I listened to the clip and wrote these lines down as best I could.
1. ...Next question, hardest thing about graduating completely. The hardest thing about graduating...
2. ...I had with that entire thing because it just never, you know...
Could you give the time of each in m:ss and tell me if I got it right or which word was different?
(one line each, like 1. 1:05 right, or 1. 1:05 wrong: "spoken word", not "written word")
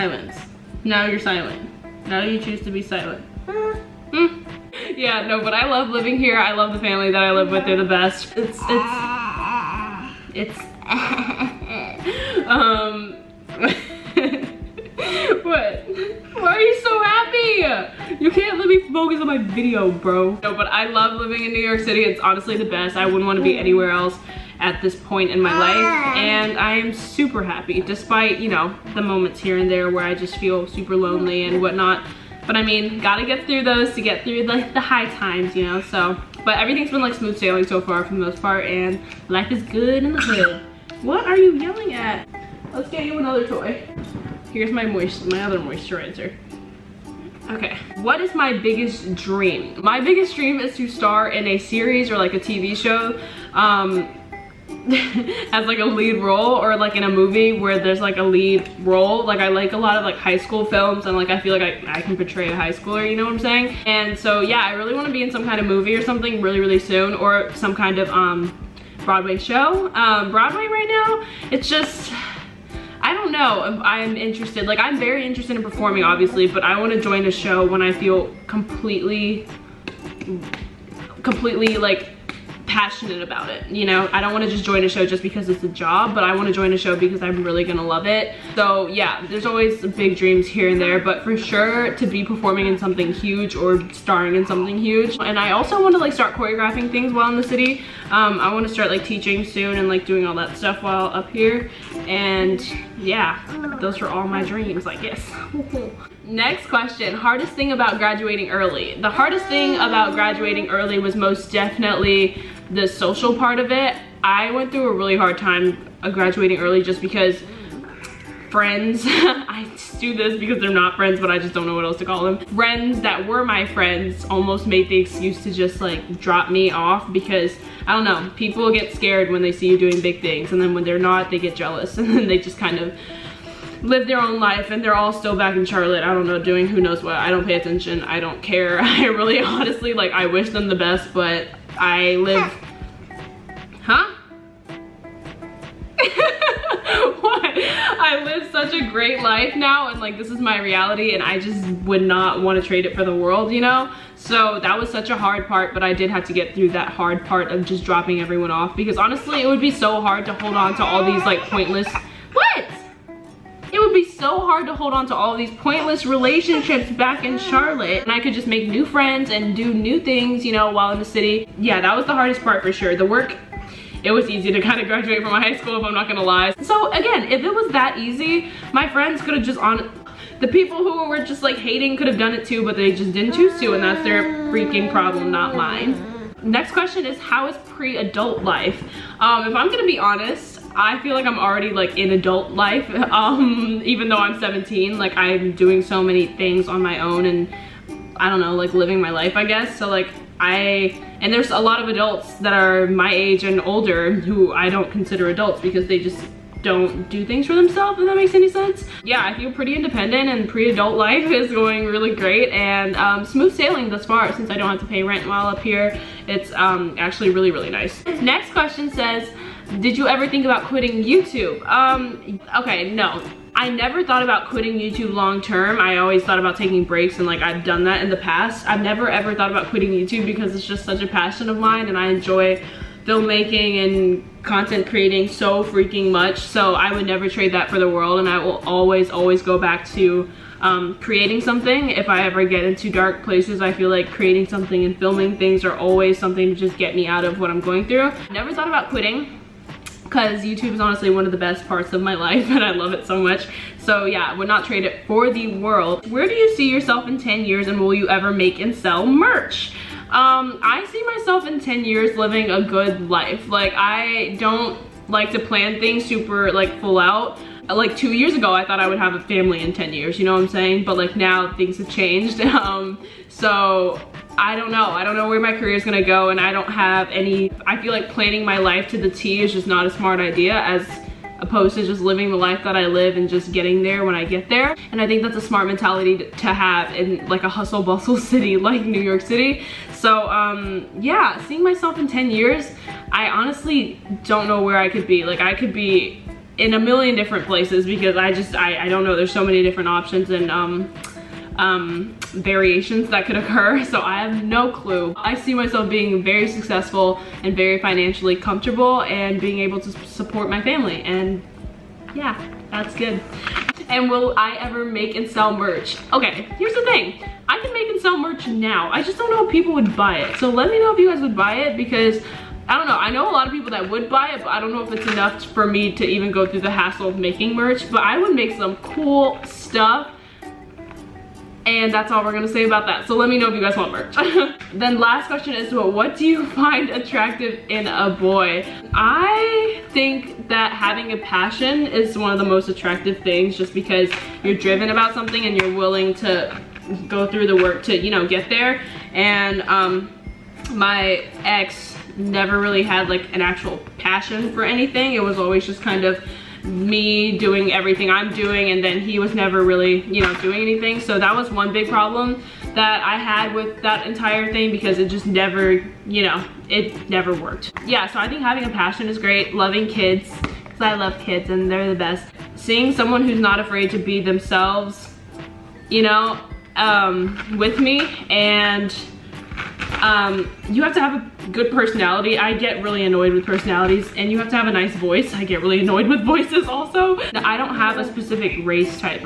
1. 1:46 wrong: "early", not "completely"
2. 6:03 right.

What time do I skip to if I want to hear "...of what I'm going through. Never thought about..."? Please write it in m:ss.
4:07.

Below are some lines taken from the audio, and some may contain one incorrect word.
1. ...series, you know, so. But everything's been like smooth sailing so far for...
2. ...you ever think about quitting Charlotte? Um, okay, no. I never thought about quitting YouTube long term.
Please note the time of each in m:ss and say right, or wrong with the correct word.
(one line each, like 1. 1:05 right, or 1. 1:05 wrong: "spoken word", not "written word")
1. 0:35 wrong: "times", not "series"
2. 3:39 wrong: "YouTube", not "Charlotte".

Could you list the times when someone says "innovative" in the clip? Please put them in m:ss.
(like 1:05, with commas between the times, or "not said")
not said.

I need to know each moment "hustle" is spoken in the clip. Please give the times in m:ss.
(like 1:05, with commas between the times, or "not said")
4:47.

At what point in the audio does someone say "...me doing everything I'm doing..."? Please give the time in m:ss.
5:56.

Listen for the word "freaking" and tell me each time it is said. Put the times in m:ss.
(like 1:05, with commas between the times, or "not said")
3:04, 3:55.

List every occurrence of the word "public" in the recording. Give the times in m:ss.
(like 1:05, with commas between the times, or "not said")
not said.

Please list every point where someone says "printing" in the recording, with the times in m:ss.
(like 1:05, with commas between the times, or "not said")
not said.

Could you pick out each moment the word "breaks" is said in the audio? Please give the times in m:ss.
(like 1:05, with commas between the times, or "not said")
3:46.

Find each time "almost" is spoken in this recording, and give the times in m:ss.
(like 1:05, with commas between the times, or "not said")
2:04.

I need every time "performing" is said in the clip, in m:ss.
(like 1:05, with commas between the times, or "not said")
1:15, 1:32.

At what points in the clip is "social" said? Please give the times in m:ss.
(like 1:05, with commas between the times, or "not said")
1:52.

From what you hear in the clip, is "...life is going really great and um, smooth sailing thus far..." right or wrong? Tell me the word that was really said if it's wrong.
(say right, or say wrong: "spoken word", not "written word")
right.